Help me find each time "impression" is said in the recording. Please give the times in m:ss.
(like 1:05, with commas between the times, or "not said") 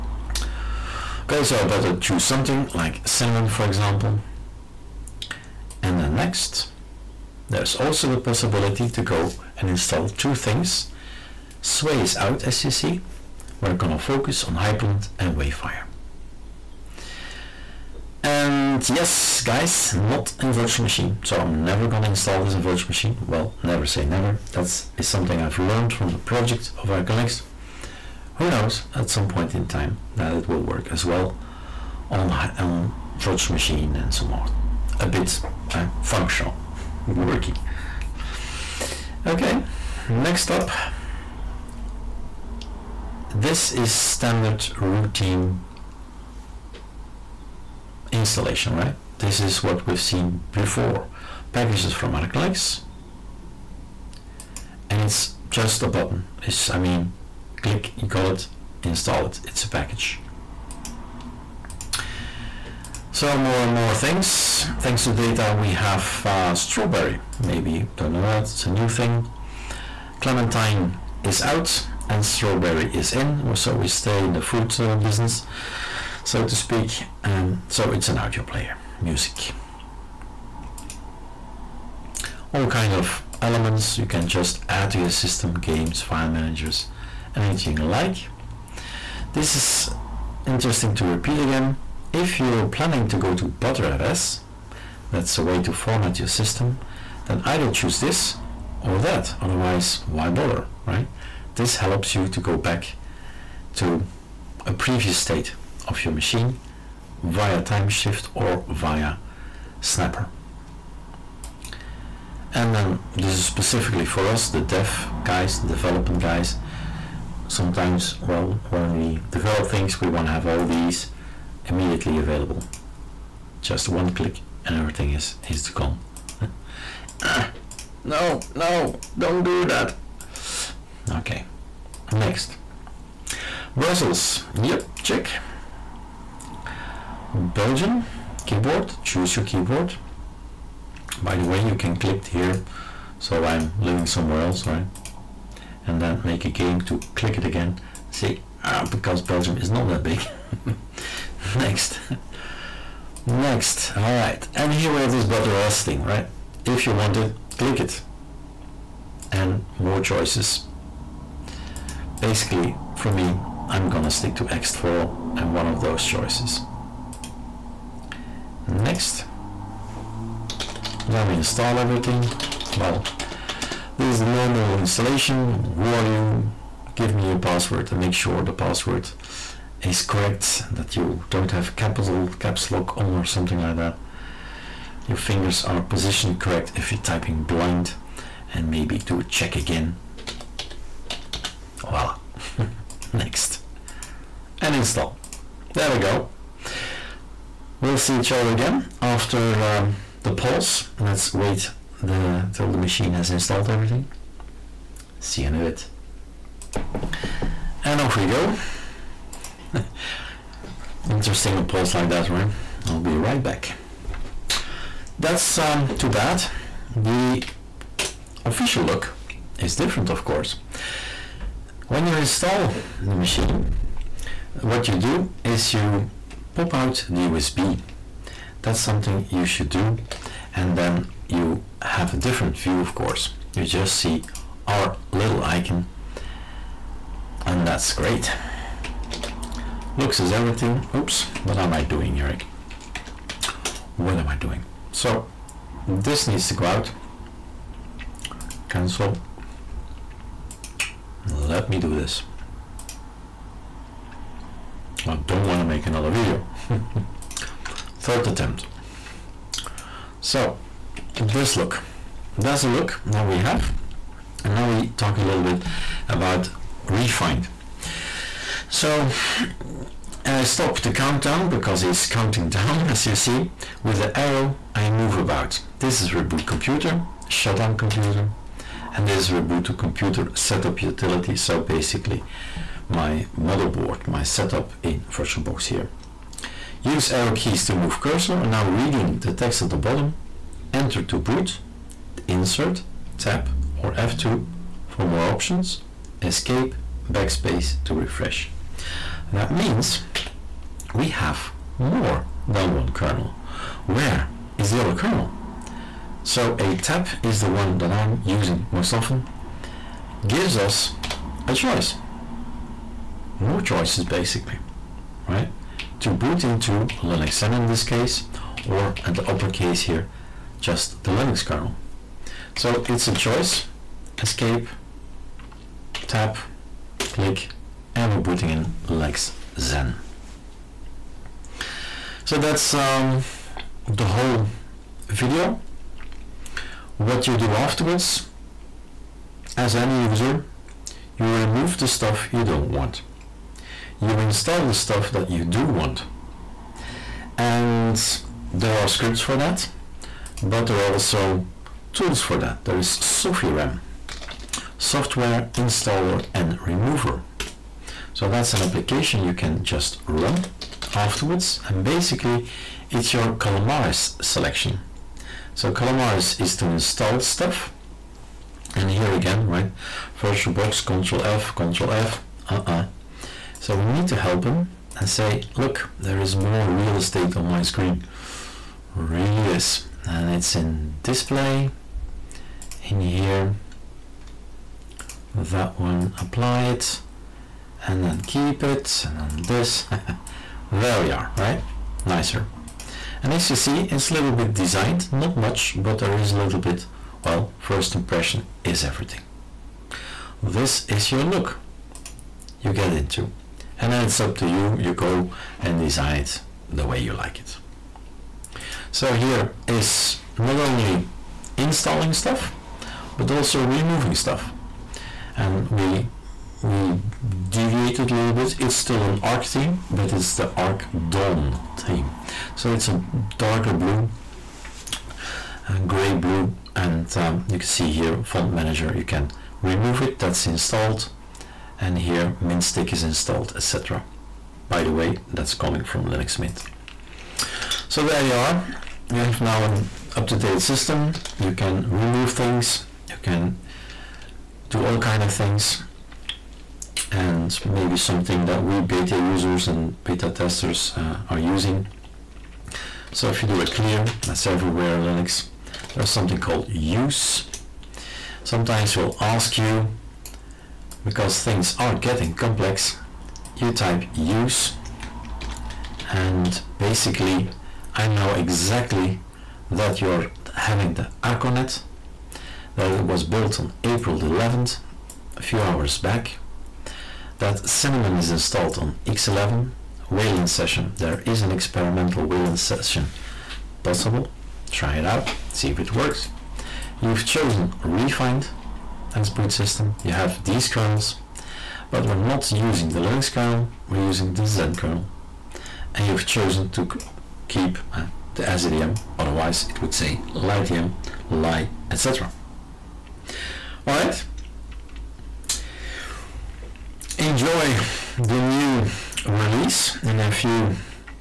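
6:37.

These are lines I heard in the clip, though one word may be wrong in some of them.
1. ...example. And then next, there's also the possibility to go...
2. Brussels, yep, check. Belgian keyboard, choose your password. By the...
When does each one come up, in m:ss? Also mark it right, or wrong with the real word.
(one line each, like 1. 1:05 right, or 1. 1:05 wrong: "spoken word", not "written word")
1. 0:03 right
2. 2:13 wrong: "keyboard", not "password".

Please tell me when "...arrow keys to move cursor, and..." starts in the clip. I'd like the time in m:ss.
4:47.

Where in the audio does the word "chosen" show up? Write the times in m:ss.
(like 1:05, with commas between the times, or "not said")
8:07, 8:16.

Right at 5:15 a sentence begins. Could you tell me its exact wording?
To boot into Linux Zen in this case, or at the upper case here, just the Linux kernel.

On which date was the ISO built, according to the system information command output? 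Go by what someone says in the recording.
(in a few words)
April 11th.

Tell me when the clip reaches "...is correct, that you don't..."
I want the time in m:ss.
2:59.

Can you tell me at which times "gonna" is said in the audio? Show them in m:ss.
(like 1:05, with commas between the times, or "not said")
0:13, 0:21, 2:43.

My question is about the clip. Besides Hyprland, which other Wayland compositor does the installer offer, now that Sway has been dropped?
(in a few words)
Wayfire.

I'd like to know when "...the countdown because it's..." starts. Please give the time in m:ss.
4:30.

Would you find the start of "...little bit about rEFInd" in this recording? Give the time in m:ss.
4:25.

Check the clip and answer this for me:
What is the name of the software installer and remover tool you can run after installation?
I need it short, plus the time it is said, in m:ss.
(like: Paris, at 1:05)
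Sofirem, at 5:52.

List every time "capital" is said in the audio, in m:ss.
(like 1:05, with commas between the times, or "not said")
3:01.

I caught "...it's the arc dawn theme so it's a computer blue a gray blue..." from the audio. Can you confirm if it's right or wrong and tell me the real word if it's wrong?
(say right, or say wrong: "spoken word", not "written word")
wrong: "darker", not "computer".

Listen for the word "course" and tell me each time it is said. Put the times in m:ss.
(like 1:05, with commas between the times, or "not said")
3:40, 3:52.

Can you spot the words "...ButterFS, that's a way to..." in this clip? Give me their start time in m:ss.
1:33.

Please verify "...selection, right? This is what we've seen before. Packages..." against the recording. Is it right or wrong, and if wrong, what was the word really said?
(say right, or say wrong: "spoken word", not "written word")
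wrong: "installation", not "selection".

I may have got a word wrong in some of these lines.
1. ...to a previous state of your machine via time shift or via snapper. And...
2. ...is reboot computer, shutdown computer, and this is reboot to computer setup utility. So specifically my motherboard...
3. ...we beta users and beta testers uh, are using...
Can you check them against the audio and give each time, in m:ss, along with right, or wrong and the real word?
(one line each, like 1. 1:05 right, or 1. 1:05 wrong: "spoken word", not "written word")
1. 1:43 right
2. 4:36 wrong: "basically", not "specifically"
3. 7:28 right.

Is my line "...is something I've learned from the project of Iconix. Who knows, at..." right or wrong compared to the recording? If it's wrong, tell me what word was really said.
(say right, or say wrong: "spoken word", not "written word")
right.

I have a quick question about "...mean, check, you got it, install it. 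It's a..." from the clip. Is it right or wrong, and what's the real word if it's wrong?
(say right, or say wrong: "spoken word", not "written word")
wrong: "click", not "check".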